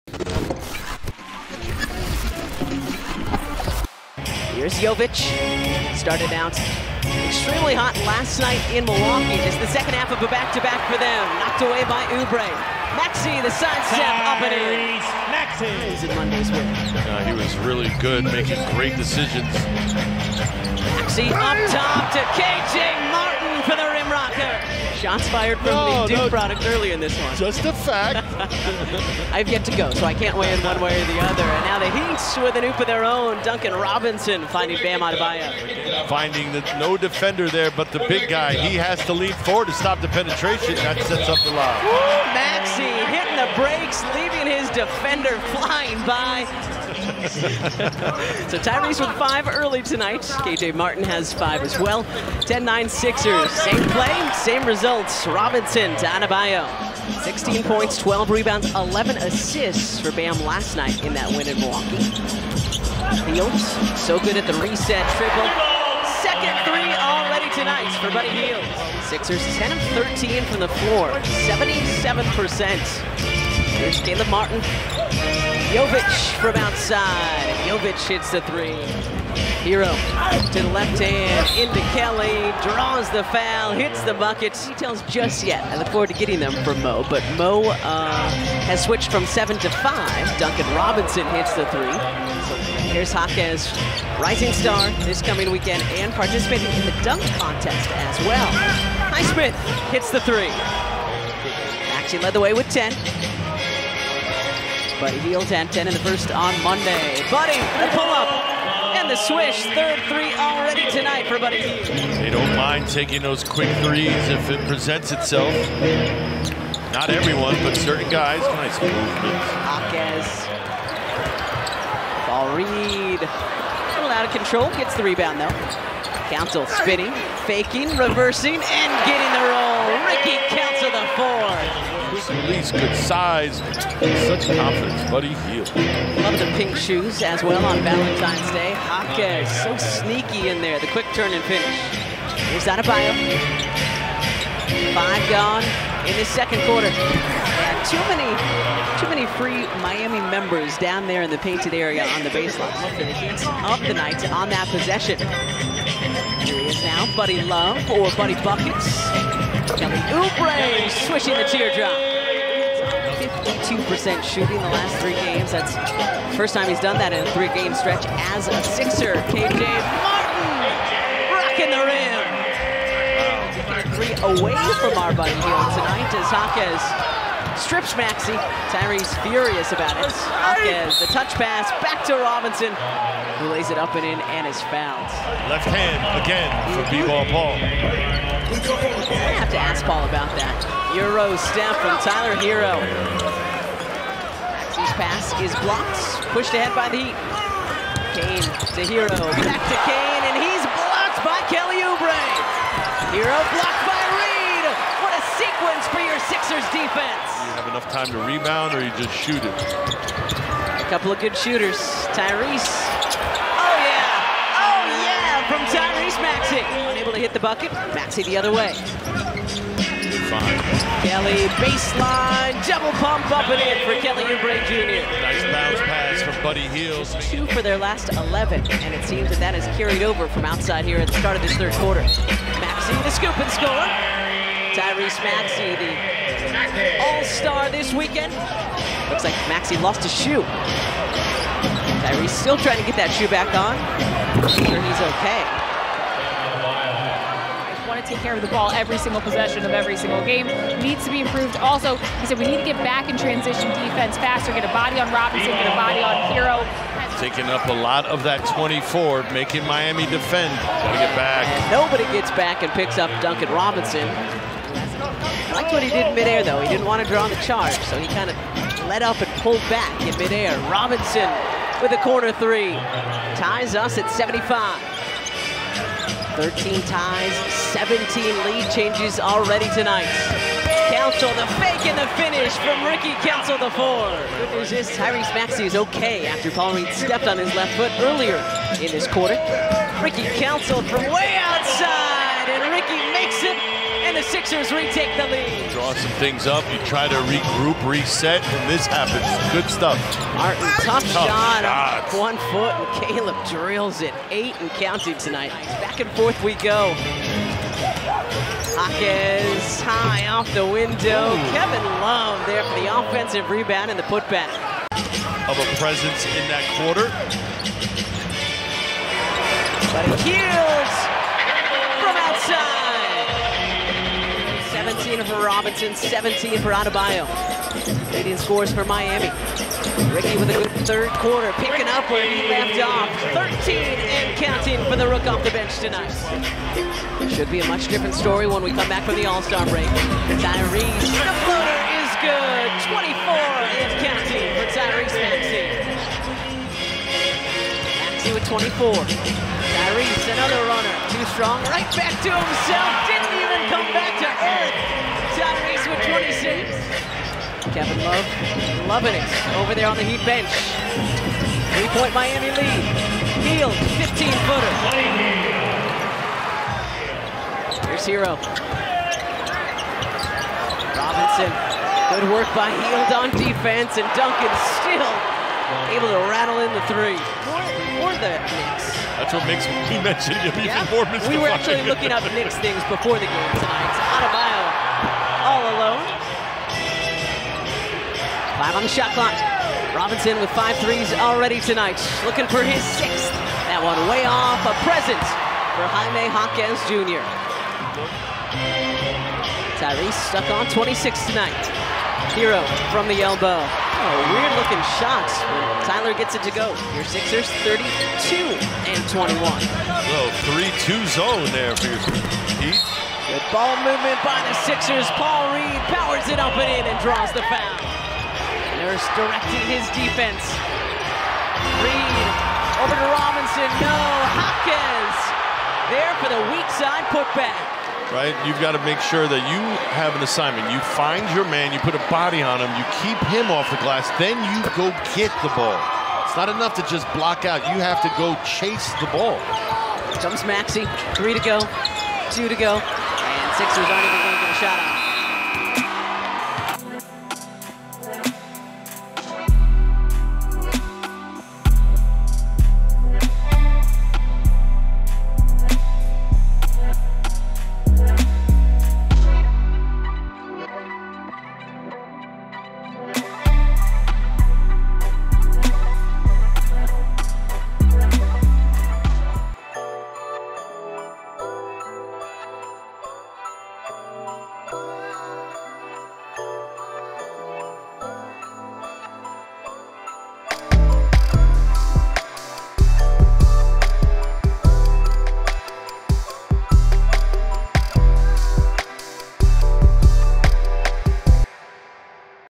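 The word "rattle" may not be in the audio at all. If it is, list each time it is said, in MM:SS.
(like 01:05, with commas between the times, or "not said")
06:16.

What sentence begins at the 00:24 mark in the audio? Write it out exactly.
Shots fired from no, the Duke no.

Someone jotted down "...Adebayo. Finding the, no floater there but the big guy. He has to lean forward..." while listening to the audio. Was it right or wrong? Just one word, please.
wrong.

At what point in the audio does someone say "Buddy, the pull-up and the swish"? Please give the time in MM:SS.
01:47.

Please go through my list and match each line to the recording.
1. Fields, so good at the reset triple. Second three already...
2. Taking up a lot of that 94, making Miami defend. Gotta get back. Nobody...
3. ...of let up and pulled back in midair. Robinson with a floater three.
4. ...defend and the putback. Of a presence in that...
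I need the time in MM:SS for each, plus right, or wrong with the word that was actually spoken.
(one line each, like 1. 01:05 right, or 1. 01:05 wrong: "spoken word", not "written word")
1. 01:03 right
2. 04:17 wrong: "24", not "94"
3. 04:28 wrong: "corner", not "floater"
4. 05:13 wrong: "rebound", not "defend".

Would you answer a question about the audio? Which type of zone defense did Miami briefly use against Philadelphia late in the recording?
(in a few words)
3-2 zone.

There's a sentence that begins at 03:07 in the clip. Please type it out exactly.
I have to ask Paul about that.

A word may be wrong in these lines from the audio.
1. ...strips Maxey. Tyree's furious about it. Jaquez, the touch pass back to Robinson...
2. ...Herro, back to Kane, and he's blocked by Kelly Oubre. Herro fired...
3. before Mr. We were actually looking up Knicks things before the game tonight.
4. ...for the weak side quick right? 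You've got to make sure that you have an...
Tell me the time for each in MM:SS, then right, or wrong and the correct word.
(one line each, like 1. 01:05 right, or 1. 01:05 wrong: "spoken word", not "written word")
1. 02:57 right
2. 03:18 wrong: "blocked", not "fired"
3. 06:20 right
4. 07:06 wrong: "putback", not "quick".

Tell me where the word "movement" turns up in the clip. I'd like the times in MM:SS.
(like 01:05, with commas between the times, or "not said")
01:58, 06:53.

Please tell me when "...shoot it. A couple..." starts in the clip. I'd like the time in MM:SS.
03:29.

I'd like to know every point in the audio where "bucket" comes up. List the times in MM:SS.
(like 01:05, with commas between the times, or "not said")
01:24, 02:38, 03:37.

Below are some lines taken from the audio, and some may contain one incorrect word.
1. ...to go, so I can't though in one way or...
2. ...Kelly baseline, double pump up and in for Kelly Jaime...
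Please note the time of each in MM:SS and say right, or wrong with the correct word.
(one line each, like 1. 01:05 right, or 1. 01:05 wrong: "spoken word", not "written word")
1. 00:29 wrong: "weigh", not "though"
2. 03:41 wrong: "Oubre", not "Jaime".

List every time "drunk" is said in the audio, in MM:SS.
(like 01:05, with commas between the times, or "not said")
not said.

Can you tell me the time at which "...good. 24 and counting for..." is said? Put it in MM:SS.
05:42.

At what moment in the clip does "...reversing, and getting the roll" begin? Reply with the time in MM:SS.
02:07.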